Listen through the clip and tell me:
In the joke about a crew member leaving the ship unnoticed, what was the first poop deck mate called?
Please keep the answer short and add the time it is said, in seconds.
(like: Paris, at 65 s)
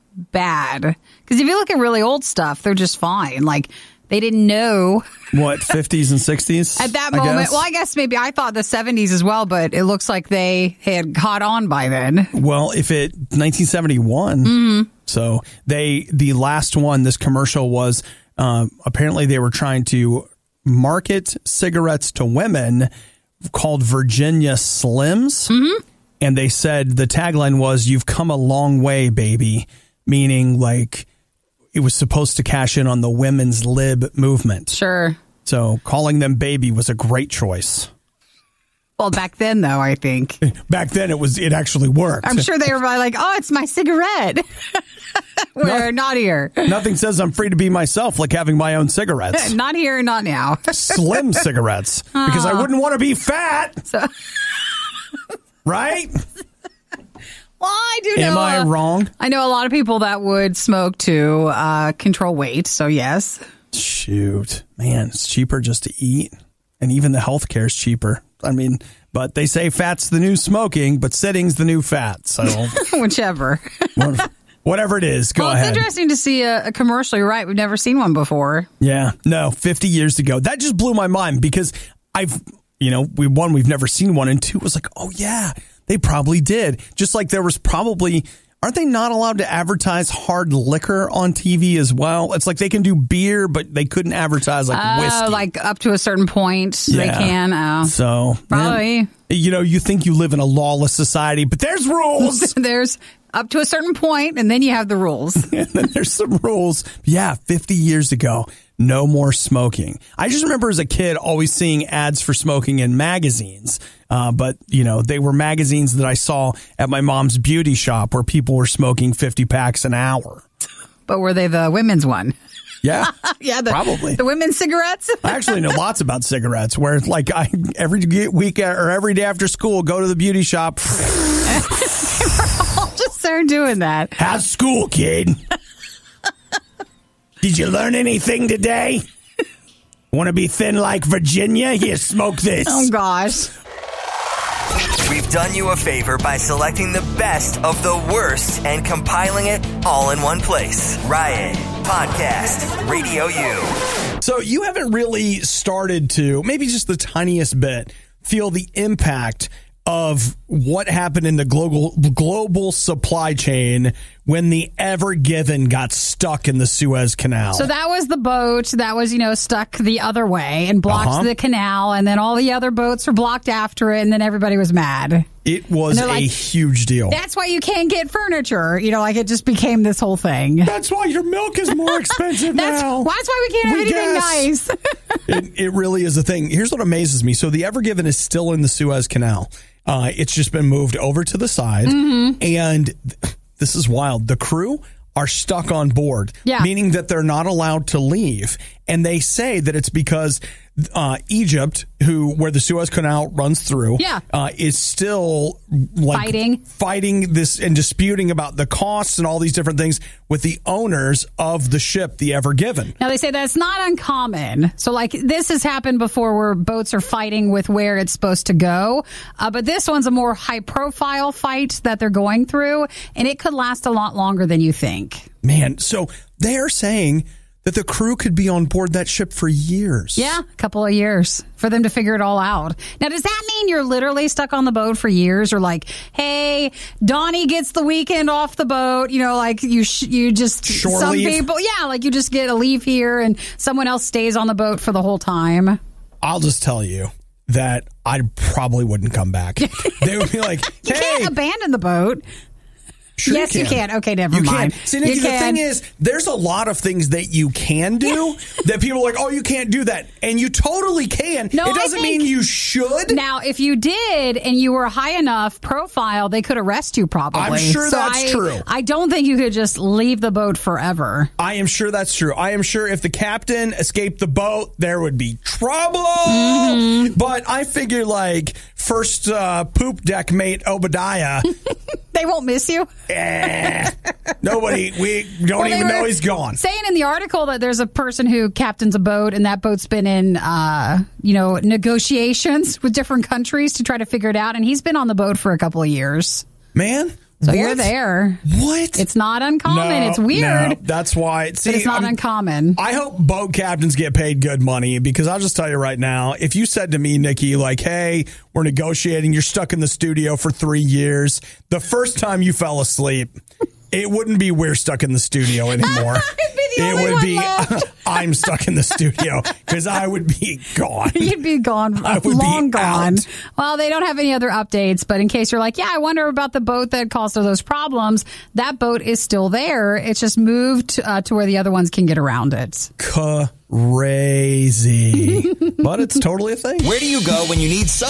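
Obadiah, at 280 s.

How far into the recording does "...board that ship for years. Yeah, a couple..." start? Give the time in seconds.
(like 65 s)
228 s.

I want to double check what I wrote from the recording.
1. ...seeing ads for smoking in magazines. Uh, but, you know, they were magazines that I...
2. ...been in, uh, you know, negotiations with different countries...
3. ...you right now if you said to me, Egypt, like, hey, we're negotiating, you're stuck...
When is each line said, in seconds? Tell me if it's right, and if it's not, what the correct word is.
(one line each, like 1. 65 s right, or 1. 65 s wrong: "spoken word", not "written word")
1. 111 s right
2. 289 s right
3. 305 s wrong: "Nikki", not "Egypt".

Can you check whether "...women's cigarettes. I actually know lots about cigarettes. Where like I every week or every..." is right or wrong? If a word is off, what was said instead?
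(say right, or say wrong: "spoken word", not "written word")
right.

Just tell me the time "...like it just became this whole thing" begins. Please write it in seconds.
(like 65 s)
179 s.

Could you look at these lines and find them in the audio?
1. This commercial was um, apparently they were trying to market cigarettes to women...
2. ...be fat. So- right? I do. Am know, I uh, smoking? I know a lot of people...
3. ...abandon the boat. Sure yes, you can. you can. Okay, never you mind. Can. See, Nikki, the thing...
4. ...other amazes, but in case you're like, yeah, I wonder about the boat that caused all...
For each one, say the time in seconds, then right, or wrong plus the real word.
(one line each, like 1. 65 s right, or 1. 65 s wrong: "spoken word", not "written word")
1. 17 s right
2. 52 s wrong: "wrong", not "smoking"
3. 251 s right
4. 324 s wrong: "updates", not "amazes".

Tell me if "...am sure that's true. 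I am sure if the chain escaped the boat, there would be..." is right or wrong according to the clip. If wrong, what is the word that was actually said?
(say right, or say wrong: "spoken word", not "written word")
wrong: "captain", not "chain".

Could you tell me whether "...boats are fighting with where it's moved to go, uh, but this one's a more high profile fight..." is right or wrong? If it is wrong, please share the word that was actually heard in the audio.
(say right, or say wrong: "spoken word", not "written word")
wrong: "supposed", not "moved".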